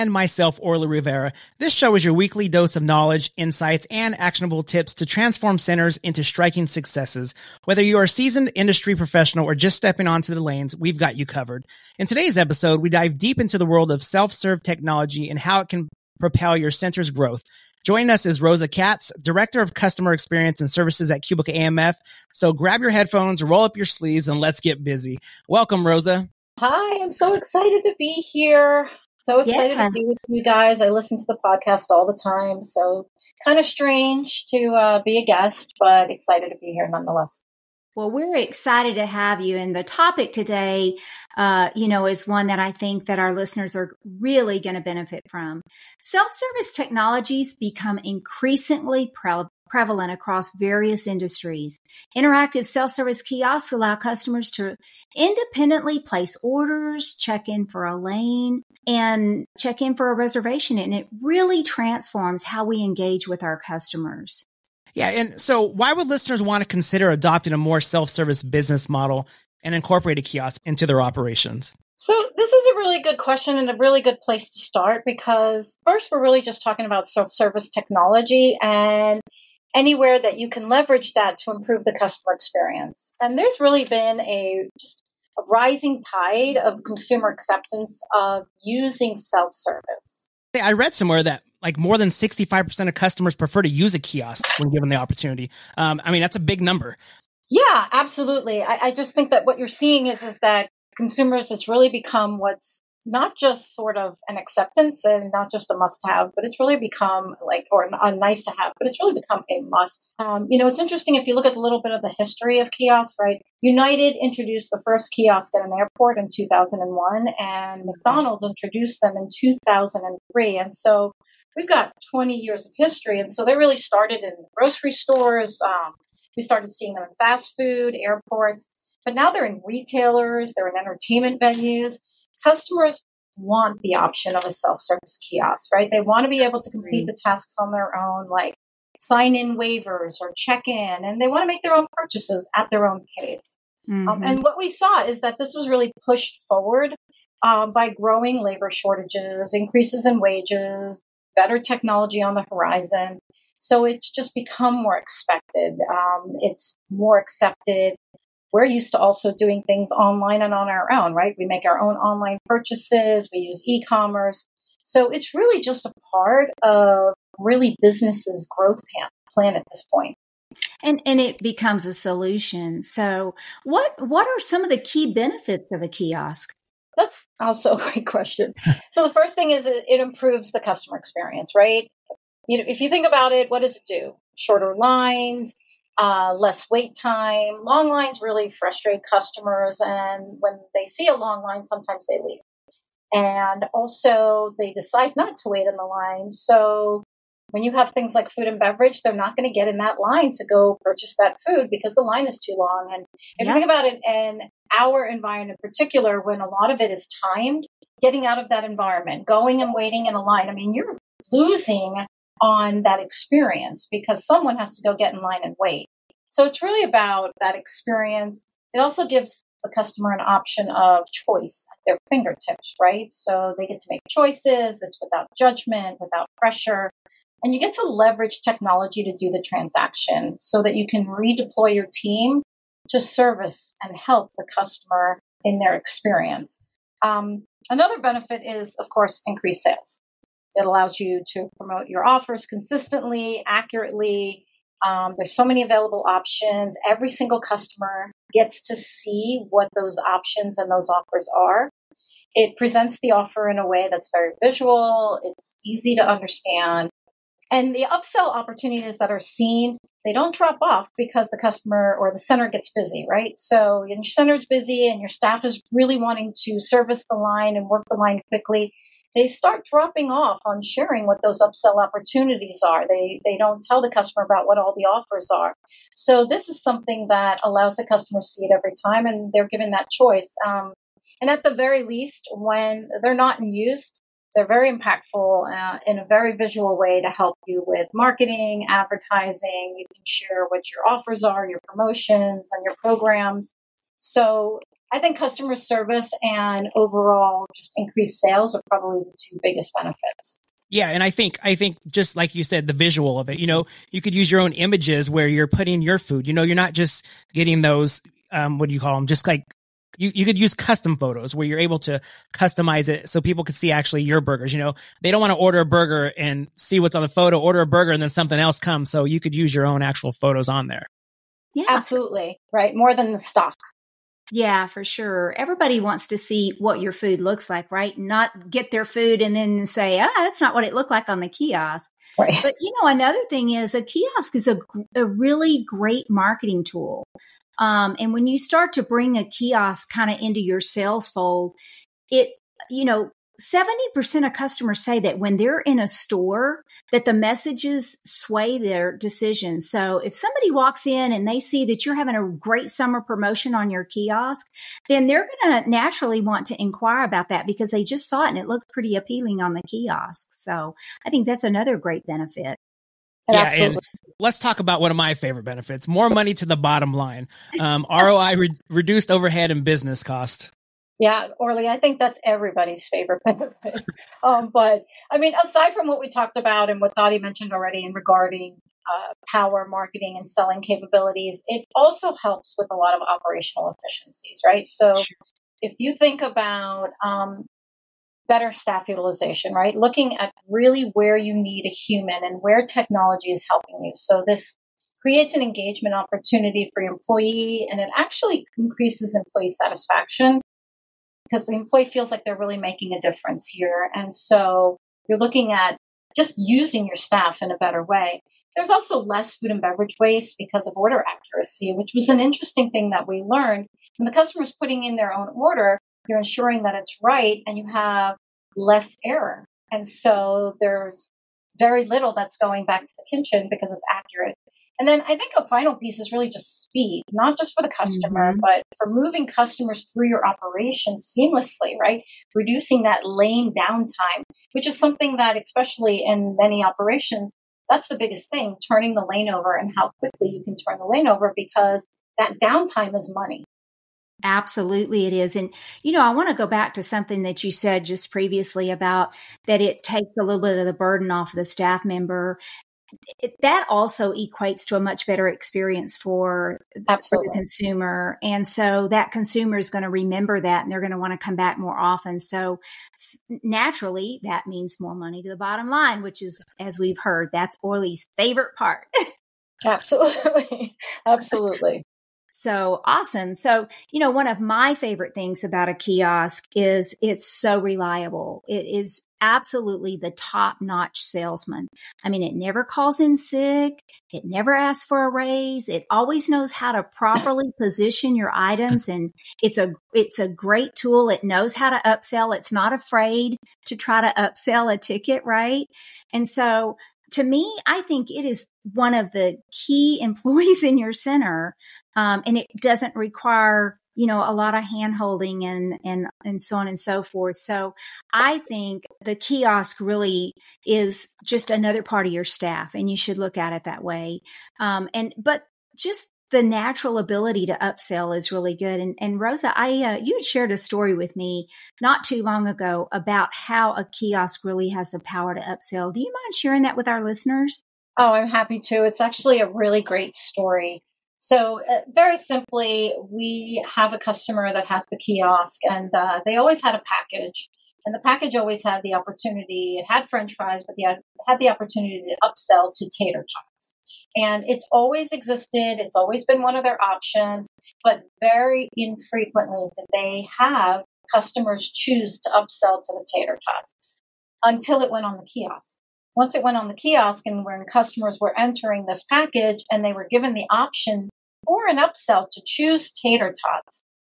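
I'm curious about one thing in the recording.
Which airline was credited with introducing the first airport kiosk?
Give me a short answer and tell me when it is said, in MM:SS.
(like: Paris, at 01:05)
United, at 01:53.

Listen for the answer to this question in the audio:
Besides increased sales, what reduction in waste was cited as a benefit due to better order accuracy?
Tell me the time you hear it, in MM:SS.
06:49.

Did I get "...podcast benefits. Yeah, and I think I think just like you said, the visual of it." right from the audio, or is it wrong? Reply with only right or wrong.
wrong.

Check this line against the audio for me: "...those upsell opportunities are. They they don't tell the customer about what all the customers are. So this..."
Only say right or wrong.
wrong.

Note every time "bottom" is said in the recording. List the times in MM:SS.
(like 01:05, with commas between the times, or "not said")
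06:06, 07:45.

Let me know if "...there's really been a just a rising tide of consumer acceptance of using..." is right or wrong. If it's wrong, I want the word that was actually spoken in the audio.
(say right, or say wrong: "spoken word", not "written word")
right.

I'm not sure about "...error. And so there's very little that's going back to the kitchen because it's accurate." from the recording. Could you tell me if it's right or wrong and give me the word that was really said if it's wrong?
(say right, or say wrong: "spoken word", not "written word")
right.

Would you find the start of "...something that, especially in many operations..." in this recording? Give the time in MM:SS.
07:14.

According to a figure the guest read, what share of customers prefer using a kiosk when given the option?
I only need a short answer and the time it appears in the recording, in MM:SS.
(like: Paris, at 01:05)
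65%, at 01:32.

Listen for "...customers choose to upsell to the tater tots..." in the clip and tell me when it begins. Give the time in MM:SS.
09:11.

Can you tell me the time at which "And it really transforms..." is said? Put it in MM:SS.
01:00.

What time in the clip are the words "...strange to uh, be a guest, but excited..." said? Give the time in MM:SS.
00:33.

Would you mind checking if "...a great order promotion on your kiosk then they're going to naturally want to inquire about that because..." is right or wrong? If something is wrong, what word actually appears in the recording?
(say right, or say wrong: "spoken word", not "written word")
wrong: "summer", not "order".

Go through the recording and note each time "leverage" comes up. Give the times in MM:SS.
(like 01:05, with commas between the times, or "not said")
01:20, 03:47.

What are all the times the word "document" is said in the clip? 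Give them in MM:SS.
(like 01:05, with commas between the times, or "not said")
not said.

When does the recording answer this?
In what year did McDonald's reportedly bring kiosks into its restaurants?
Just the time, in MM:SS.
01:59.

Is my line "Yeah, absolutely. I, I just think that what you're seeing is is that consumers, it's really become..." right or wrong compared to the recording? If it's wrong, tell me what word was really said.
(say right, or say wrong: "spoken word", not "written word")
right.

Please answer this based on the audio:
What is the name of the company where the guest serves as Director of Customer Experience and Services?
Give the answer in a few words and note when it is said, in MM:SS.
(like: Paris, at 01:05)
Cubic AMF, at 00:21.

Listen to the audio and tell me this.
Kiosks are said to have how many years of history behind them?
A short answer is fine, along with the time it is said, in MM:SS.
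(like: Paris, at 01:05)
20 years, at 02:02.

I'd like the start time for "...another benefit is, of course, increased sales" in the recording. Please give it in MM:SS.
03:57.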